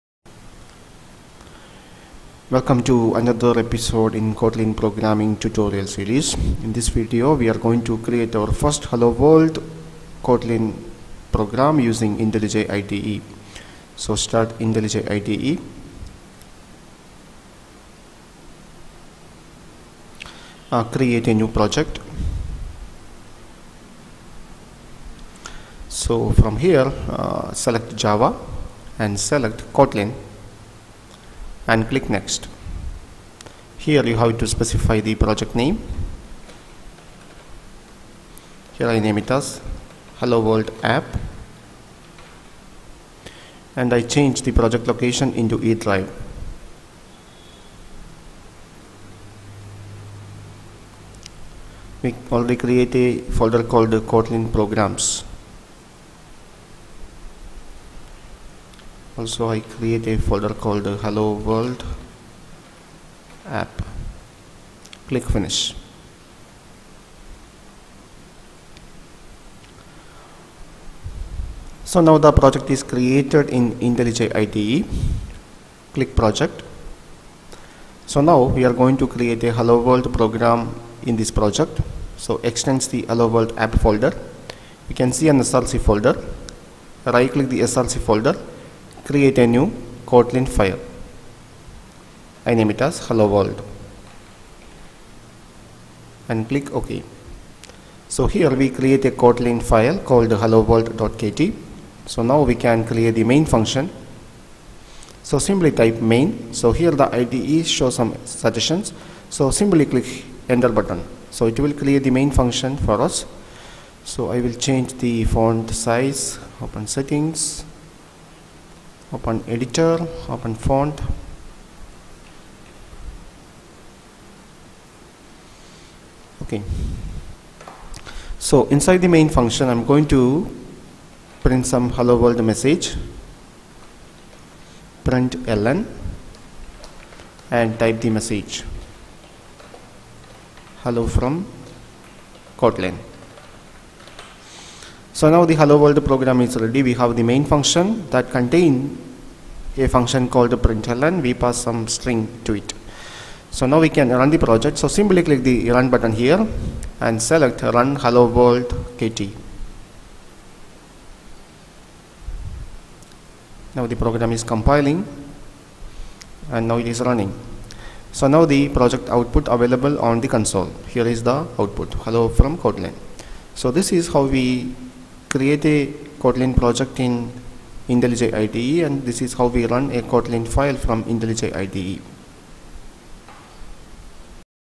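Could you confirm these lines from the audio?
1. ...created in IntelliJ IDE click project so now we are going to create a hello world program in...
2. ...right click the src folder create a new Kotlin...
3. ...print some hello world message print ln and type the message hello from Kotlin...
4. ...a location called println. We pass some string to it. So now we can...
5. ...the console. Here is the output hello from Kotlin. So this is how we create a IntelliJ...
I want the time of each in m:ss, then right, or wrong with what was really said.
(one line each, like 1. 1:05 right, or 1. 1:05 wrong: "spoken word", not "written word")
1. 1:12 right
2. 1:27 right
3. 2:11 right
4. 2:29 wrong: "function", not "location"
5. 2:50 wrong: "Kotlin", not "IntelliJ".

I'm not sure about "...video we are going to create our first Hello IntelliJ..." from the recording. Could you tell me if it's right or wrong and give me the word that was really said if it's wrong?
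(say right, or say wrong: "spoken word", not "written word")
wrong: "World", not "IntelliJ".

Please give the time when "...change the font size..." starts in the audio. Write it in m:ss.
1:54.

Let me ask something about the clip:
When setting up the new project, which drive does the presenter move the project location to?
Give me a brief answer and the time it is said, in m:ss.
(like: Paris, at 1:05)
E drive, at 0:45.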